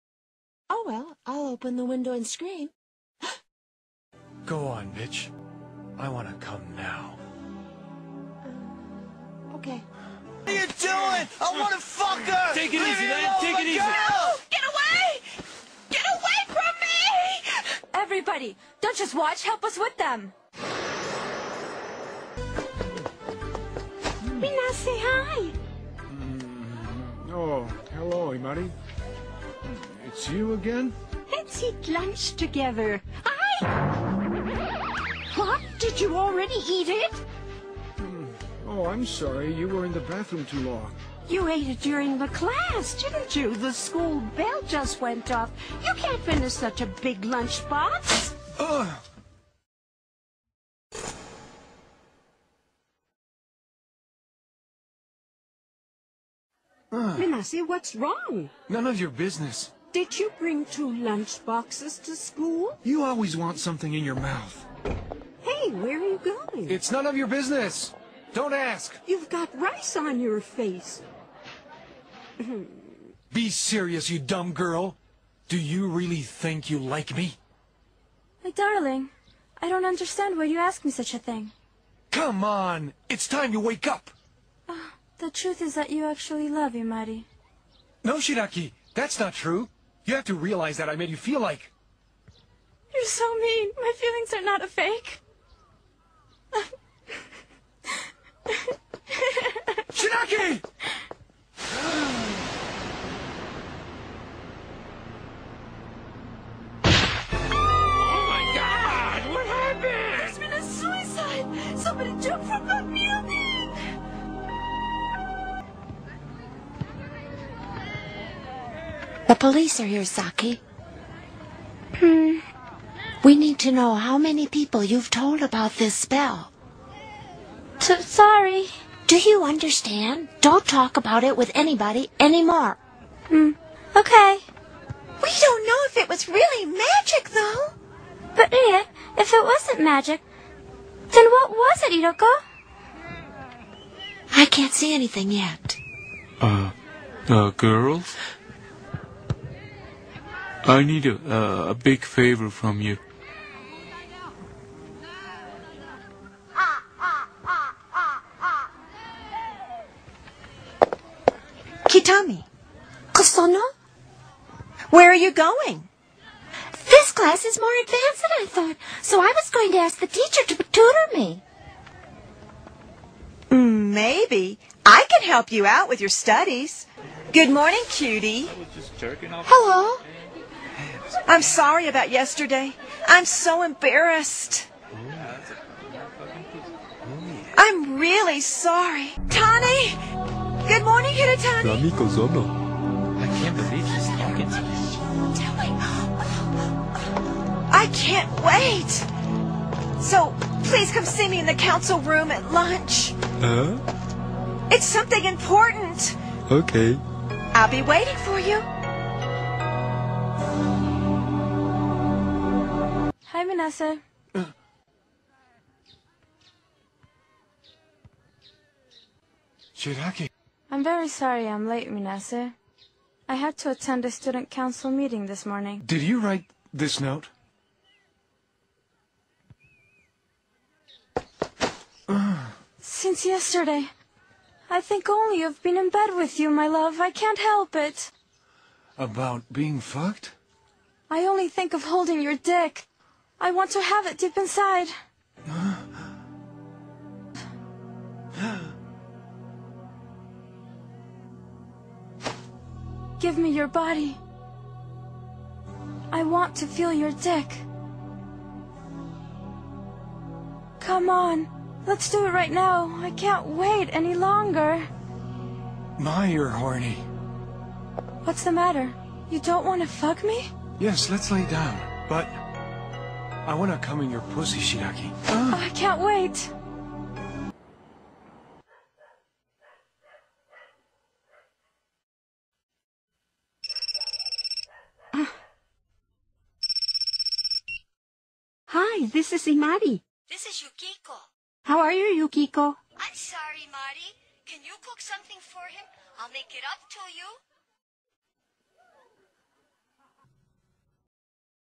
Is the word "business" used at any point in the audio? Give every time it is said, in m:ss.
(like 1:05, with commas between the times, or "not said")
0:59, 1:07.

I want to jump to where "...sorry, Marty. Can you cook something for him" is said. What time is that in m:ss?
4:53.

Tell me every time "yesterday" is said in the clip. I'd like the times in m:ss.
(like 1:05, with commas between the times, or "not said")
3:02, 3:53.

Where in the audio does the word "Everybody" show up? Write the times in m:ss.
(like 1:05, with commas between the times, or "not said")
0:17.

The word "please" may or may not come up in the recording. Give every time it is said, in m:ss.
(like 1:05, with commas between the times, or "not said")
3:20.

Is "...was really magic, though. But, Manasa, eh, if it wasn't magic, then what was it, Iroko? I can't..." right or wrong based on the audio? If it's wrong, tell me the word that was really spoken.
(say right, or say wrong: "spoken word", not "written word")
wrong: "Ria", not "Manasa".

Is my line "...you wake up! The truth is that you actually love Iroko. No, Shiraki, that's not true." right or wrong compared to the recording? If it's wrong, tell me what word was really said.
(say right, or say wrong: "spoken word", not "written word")
wrong: "Imari", not "Iroko".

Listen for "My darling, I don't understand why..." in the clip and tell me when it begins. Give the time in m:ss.
1:18.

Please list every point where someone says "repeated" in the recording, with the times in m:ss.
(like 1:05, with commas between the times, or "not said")
not said.